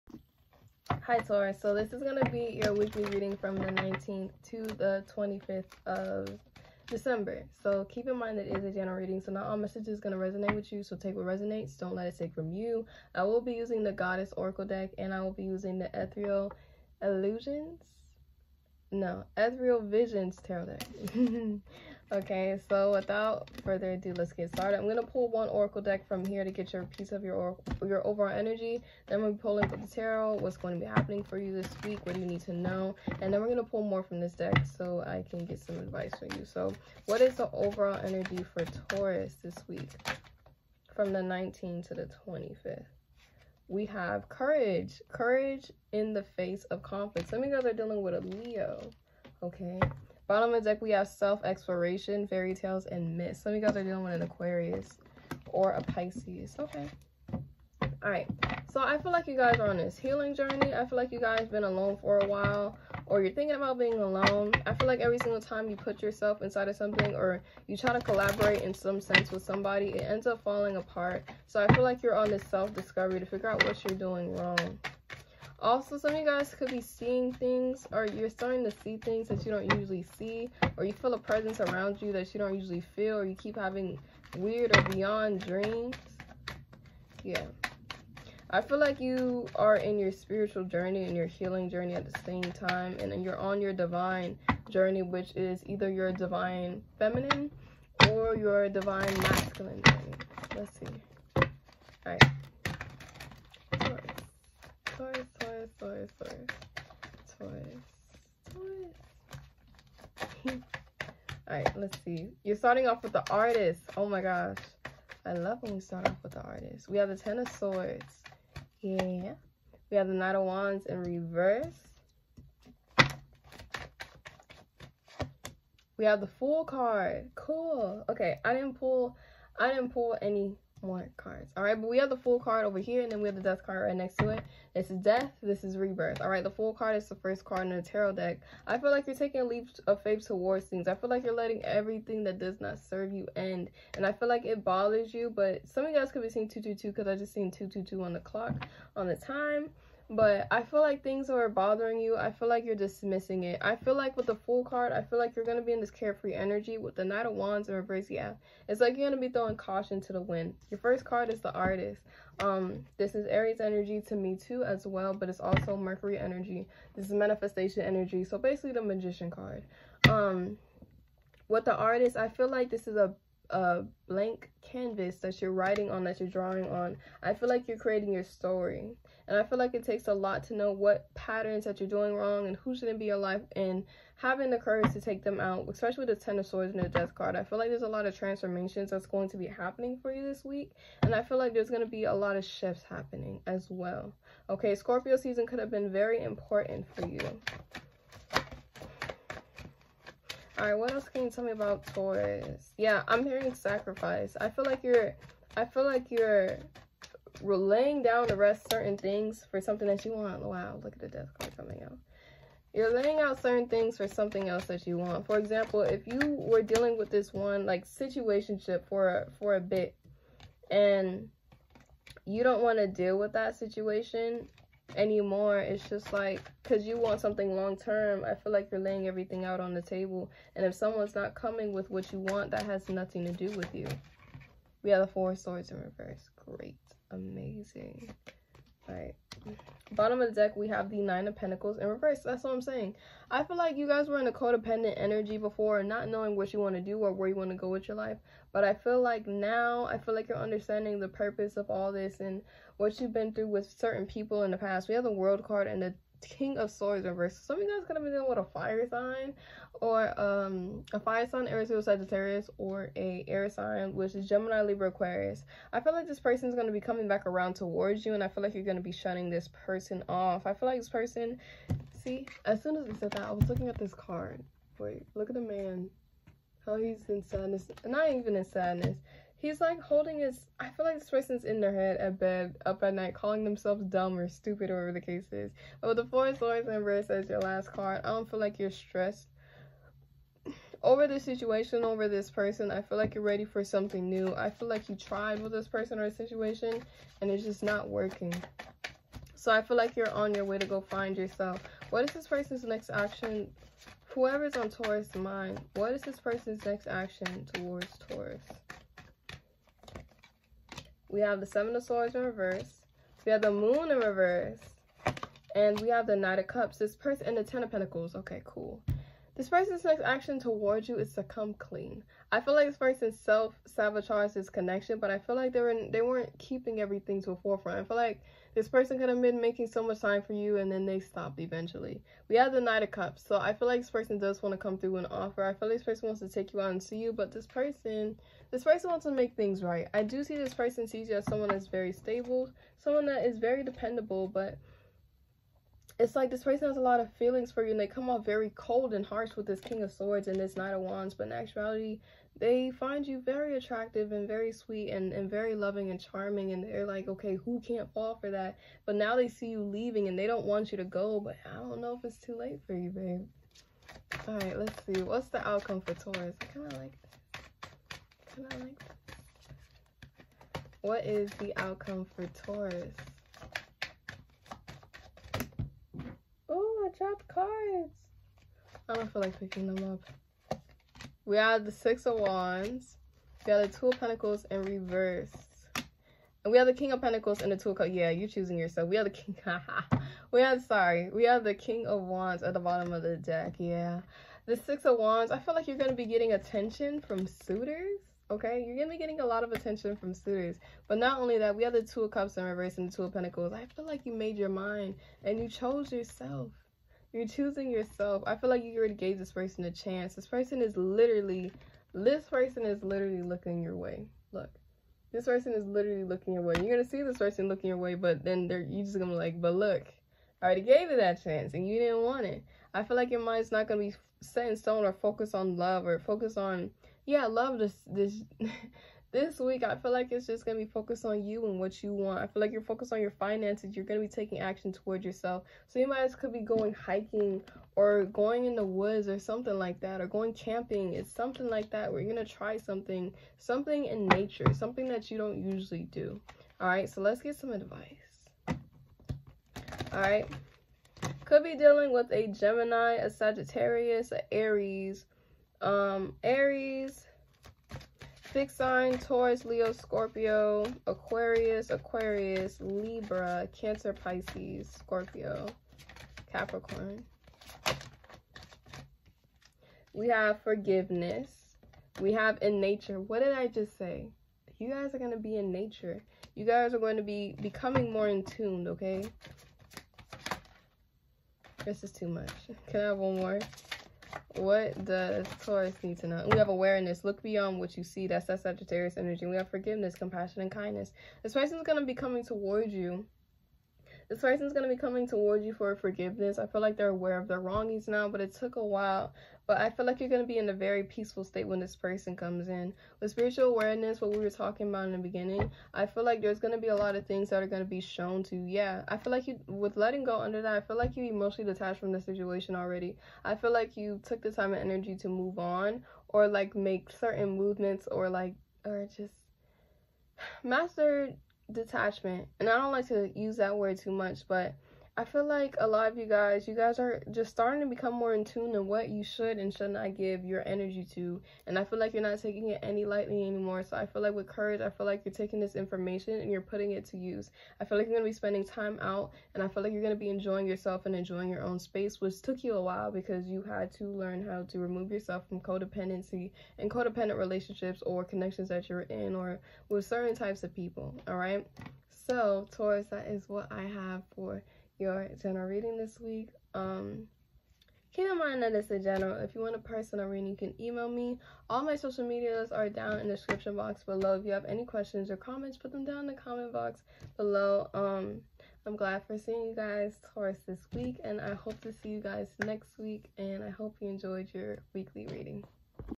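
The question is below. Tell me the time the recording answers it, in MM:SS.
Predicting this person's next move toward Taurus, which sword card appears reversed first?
05:11.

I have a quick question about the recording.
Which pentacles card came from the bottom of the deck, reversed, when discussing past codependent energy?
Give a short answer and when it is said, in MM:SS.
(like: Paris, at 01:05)
Nine of Pentacles, at 04:01.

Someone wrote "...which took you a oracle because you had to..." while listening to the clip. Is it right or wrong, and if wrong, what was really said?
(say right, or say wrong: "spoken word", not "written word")
wrong: "while", not "oracle".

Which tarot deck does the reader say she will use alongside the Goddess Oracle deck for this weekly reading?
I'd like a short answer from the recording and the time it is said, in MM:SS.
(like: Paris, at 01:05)
Ethereal Visions Tarot, at 00:19.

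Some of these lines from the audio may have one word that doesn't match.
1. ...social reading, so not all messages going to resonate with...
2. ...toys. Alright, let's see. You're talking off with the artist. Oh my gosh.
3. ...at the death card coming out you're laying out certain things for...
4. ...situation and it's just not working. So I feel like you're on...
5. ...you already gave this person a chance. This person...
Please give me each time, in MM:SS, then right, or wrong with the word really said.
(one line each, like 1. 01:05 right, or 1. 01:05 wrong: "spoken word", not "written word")
1. 00:08 wrong: "general", not "social"
2. 01:50 wrong: "starting", not "talking"
3. 03:30 right
4. 04:56 right
5. 06:48 right.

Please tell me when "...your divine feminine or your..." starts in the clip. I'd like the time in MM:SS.
01:35.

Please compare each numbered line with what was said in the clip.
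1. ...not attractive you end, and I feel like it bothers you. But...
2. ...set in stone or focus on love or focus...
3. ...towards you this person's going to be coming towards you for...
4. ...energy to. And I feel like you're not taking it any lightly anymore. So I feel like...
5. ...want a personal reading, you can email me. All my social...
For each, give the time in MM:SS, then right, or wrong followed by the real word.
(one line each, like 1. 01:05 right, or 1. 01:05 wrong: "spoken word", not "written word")
1. 02:22 wrong: "serve", not "attractive"
2. 07:04 right
3. 08:12 right
4. 08:50 right
5. 09:19 right.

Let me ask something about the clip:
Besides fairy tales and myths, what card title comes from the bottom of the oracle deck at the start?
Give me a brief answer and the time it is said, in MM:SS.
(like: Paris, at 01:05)
Self-exploration, at 00:51.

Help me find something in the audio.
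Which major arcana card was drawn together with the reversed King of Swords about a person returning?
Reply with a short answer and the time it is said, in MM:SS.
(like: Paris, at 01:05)
The World, at 04:15.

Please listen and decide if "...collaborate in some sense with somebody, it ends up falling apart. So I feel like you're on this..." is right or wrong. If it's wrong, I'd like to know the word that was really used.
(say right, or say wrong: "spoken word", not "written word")
right.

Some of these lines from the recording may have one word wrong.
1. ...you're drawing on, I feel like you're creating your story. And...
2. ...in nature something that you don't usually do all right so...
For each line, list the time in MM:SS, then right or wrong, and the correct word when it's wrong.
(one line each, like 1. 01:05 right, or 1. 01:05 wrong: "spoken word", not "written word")
1. 02:56 right
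2. 07:23 right.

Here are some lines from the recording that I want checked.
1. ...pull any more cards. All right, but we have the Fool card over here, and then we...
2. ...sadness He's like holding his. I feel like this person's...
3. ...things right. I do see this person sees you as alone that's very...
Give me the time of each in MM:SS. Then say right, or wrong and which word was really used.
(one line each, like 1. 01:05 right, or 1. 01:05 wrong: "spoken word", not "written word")
1. 02:09 right
2. 04:38 right
3. 05:39 wrong: "someone", not "alone".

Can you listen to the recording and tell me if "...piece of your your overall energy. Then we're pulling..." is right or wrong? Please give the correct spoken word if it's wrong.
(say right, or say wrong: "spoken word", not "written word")
right.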